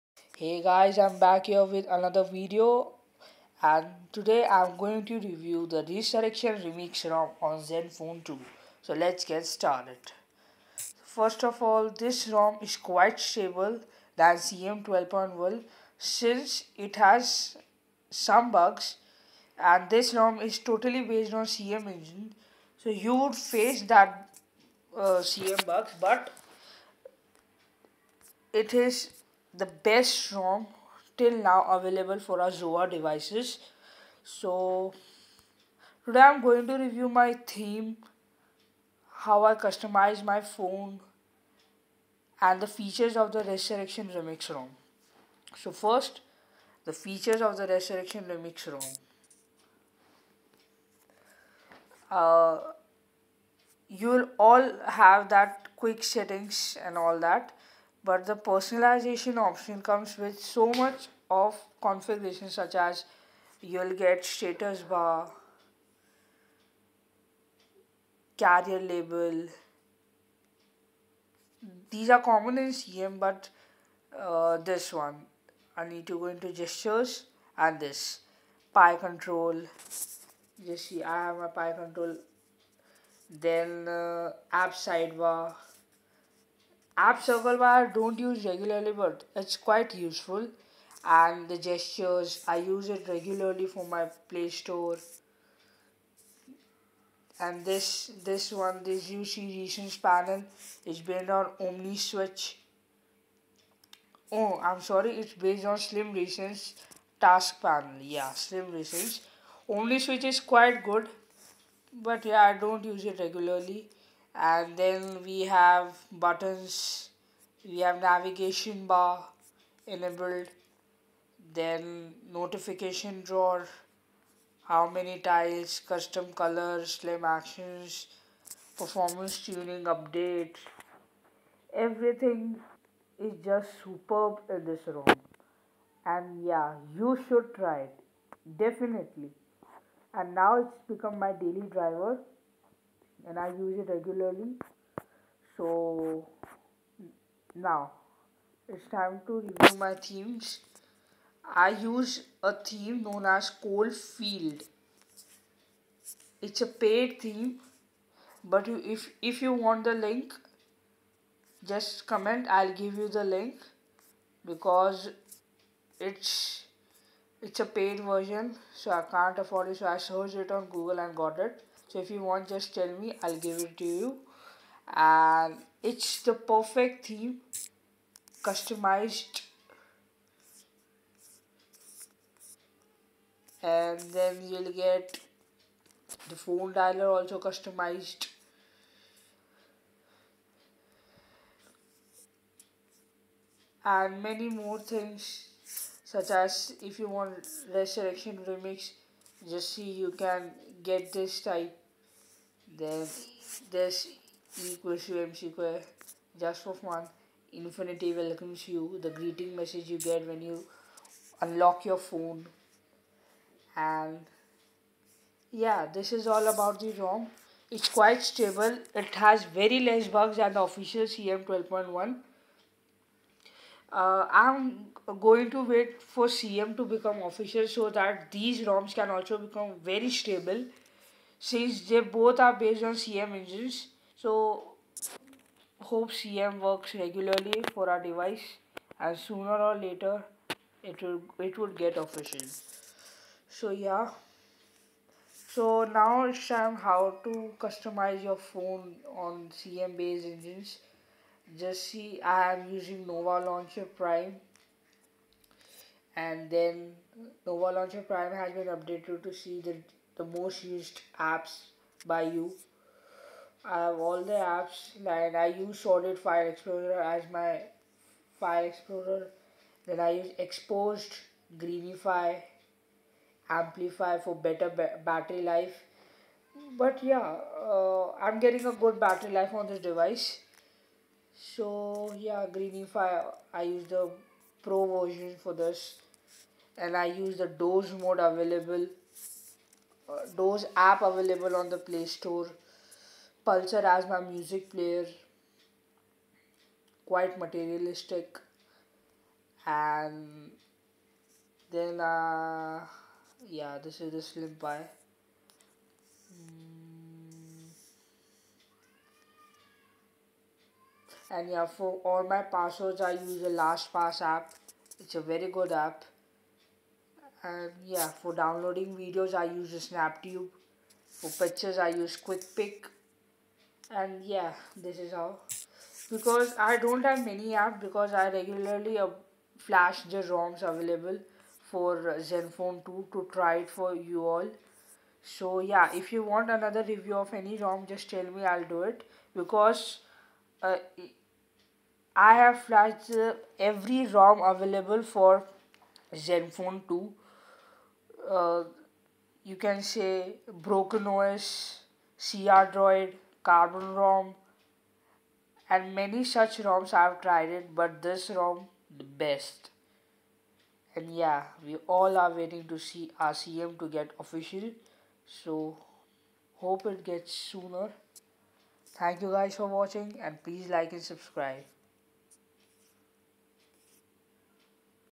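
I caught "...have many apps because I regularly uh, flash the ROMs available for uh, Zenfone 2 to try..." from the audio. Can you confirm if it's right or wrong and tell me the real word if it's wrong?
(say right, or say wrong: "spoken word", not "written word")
right.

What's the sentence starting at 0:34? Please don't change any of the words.
So today I'm going to review my theme, how I customize my phone and the features of the Resurrection Remix ROM.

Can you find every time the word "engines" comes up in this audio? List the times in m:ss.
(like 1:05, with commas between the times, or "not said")
0:21, 3:53, 4:10.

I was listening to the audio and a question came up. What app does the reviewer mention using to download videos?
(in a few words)
SnapTube.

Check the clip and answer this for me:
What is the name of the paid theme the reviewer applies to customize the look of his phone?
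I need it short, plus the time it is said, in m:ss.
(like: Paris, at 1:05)
Coalfield, at 2:33.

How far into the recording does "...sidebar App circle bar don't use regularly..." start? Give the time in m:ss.
1:24.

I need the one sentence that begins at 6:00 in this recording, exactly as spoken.
And yeah, we all are waiting to see RCM to get official.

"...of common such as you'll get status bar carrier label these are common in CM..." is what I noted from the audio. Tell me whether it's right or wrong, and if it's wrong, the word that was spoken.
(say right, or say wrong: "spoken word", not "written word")
wrong: "configuration", not "common".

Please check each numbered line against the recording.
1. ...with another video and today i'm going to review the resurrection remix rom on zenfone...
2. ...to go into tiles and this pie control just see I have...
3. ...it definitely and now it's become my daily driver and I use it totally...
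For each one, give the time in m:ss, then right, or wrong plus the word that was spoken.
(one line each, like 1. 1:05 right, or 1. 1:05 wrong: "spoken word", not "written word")
1. 0:01 right
2. 1:16 wrong: "gestures", not "tiles"
3. 2:17 wrong: "regularly", not "totally".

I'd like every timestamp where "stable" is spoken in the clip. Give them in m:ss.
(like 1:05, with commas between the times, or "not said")
0:13, 3:38, 3:50.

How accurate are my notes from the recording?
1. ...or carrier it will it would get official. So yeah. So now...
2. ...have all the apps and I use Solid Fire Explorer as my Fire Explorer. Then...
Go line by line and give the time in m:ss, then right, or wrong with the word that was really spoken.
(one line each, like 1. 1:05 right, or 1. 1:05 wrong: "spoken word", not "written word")
1. 3:59 wrong: "later", not "carrier"
2. 4:23 right.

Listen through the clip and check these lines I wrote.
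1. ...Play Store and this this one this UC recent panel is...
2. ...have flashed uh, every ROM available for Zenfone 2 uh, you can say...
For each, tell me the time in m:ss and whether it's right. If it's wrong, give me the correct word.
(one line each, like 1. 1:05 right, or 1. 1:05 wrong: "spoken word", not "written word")
1. 1:34 right
2. 5:42 right.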